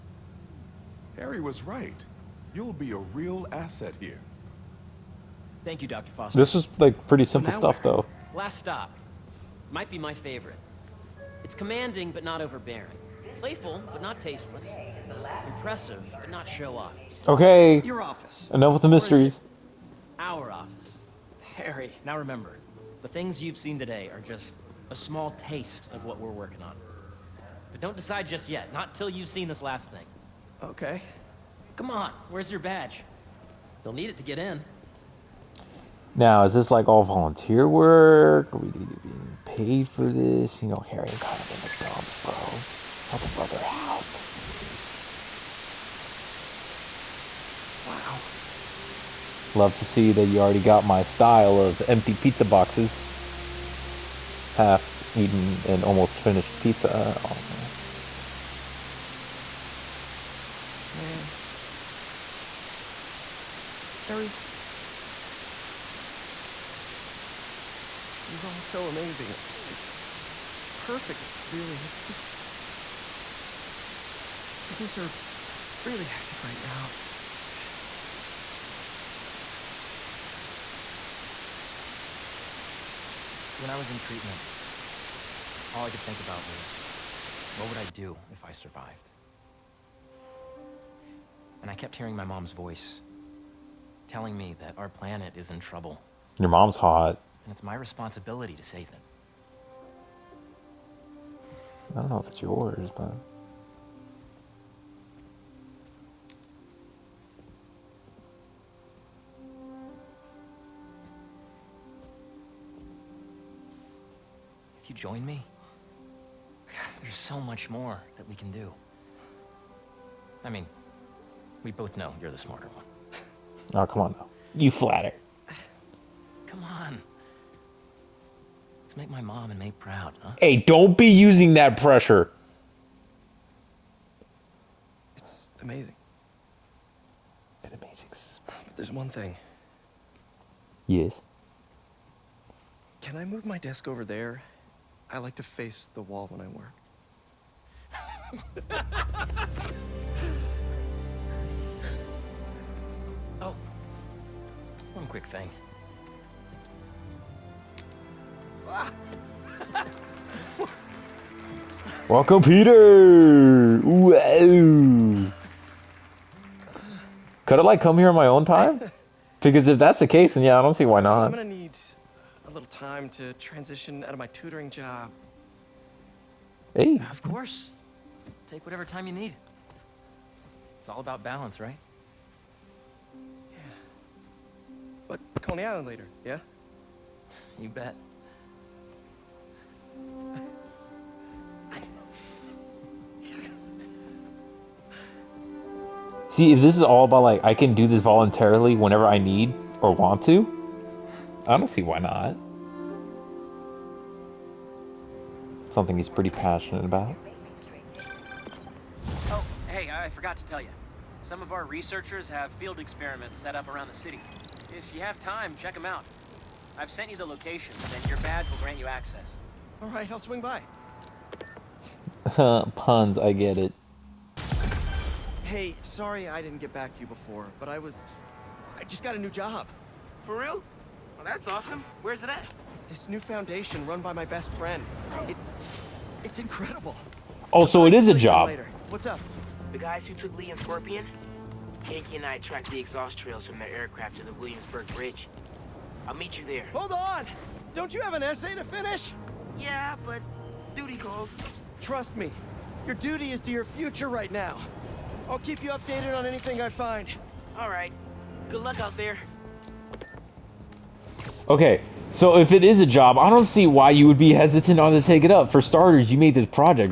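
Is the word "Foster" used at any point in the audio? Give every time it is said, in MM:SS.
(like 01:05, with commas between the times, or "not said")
00:06.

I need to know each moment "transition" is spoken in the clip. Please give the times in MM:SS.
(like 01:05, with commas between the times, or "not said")
02:53.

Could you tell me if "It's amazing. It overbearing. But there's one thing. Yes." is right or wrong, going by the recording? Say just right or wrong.
wrong.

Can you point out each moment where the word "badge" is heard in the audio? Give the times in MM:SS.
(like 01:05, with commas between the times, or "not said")
00:32, 03:38.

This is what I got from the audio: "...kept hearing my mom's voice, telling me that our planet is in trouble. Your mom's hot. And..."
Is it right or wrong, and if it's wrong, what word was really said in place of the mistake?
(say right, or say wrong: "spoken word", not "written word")
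right.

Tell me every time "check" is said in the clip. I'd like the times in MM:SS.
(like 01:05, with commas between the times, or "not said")
03:35.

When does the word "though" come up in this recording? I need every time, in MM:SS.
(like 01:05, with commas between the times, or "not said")
00:07, 02:04.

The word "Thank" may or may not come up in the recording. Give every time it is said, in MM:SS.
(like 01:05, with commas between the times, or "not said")
00:05.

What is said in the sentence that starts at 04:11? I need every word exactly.
Trust me, your duty is to your future right now.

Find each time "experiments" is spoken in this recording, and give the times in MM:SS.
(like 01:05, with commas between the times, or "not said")
03:32.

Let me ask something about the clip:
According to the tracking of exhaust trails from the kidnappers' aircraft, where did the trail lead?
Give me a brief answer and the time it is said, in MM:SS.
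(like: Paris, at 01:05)
Williamsburg Bridge, at 04:04.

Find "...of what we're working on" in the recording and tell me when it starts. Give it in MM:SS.
00:25.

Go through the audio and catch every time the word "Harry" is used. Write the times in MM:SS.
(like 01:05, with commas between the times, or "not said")
00:01, 00:21, 00:40, 01:04.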